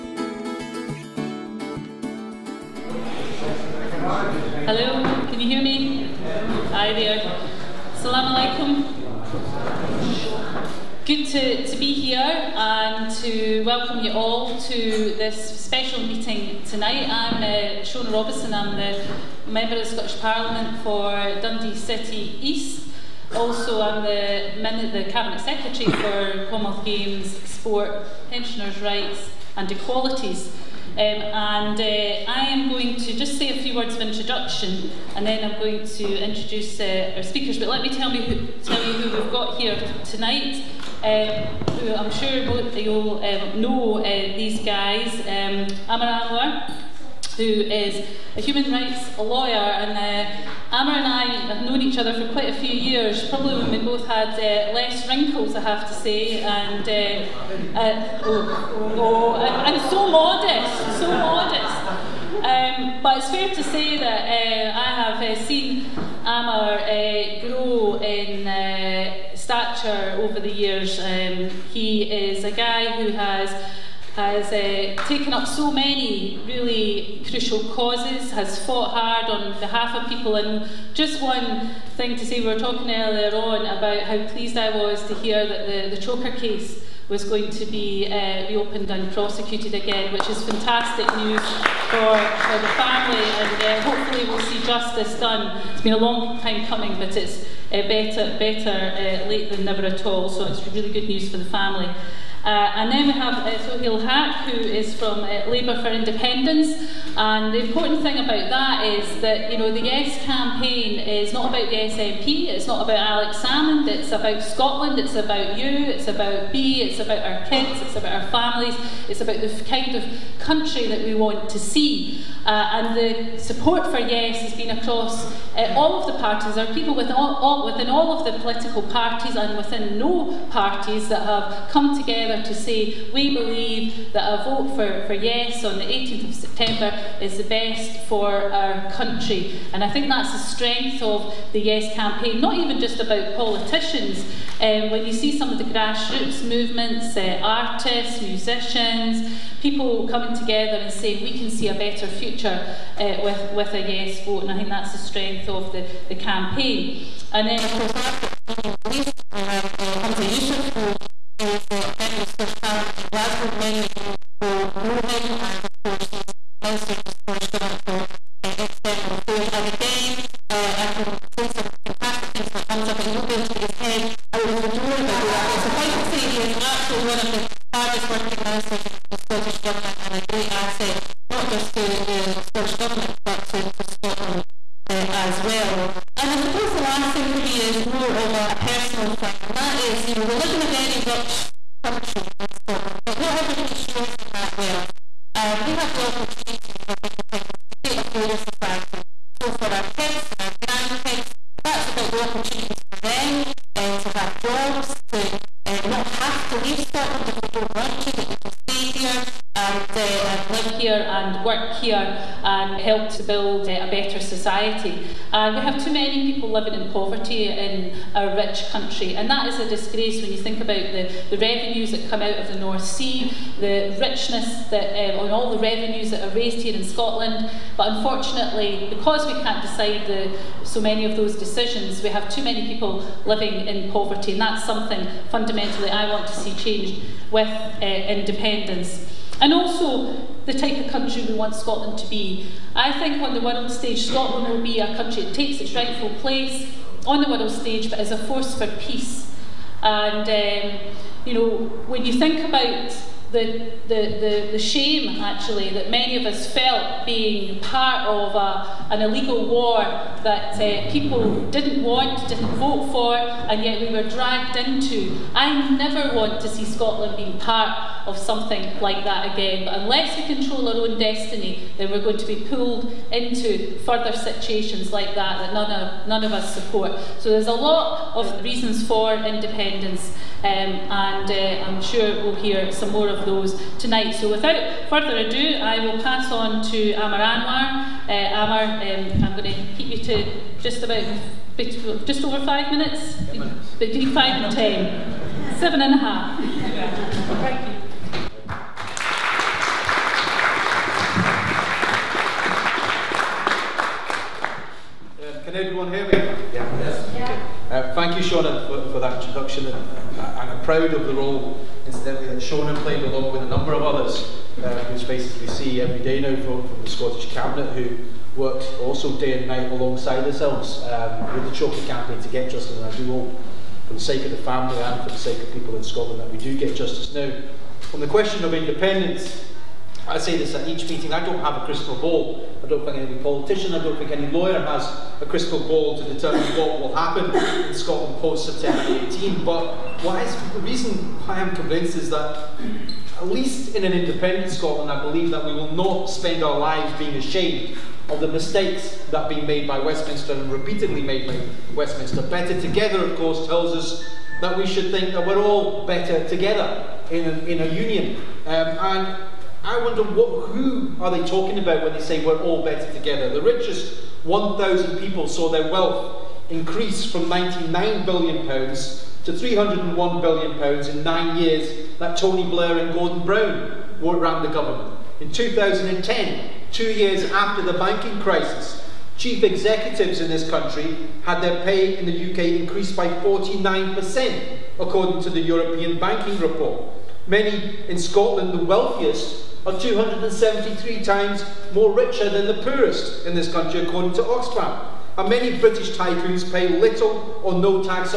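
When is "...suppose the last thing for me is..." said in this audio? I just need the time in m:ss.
3:06.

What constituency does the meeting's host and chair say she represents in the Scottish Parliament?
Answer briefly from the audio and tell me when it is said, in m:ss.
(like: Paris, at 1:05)
Dundee City East, at 0:21.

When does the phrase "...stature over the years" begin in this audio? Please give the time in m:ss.
1:09.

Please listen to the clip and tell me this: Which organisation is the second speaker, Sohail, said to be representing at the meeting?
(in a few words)
Labour for Independence.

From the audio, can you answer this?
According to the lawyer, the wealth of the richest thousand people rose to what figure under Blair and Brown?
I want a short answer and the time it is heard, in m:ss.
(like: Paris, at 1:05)
301 billion pounds, at 6:09.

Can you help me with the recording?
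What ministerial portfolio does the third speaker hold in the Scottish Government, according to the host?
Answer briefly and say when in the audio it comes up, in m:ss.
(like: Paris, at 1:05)
External Affairs, at 2:48.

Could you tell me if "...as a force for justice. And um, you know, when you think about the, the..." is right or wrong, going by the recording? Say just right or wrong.
wrong.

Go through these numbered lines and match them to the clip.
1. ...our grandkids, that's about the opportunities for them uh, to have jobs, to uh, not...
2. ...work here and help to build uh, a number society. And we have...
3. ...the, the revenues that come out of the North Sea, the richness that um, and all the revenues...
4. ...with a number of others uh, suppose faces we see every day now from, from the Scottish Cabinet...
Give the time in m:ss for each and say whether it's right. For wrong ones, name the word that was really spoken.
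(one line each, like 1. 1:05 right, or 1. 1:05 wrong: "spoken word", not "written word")
1. 3:20 right
2. 3:31 wrong: "better", not "number"
3. 3:40 right
4. 5:13 wrong: "whose", not "suppose".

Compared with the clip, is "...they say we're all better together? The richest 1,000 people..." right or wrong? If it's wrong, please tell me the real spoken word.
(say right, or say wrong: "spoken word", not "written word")
right.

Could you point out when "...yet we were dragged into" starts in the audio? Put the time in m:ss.
4:23.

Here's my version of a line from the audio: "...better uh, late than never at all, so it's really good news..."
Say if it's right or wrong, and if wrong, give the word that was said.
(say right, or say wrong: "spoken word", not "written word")
right.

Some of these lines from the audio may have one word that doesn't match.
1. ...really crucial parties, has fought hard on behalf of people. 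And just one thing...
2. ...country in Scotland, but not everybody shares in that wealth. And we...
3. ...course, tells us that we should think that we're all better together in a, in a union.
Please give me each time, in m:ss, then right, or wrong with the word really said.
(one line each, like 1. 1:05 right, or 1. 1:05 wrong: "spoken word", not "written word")
1. 1:16 wrong: "causes", not "parties"
2. 3:11 right
3. 5:53 right.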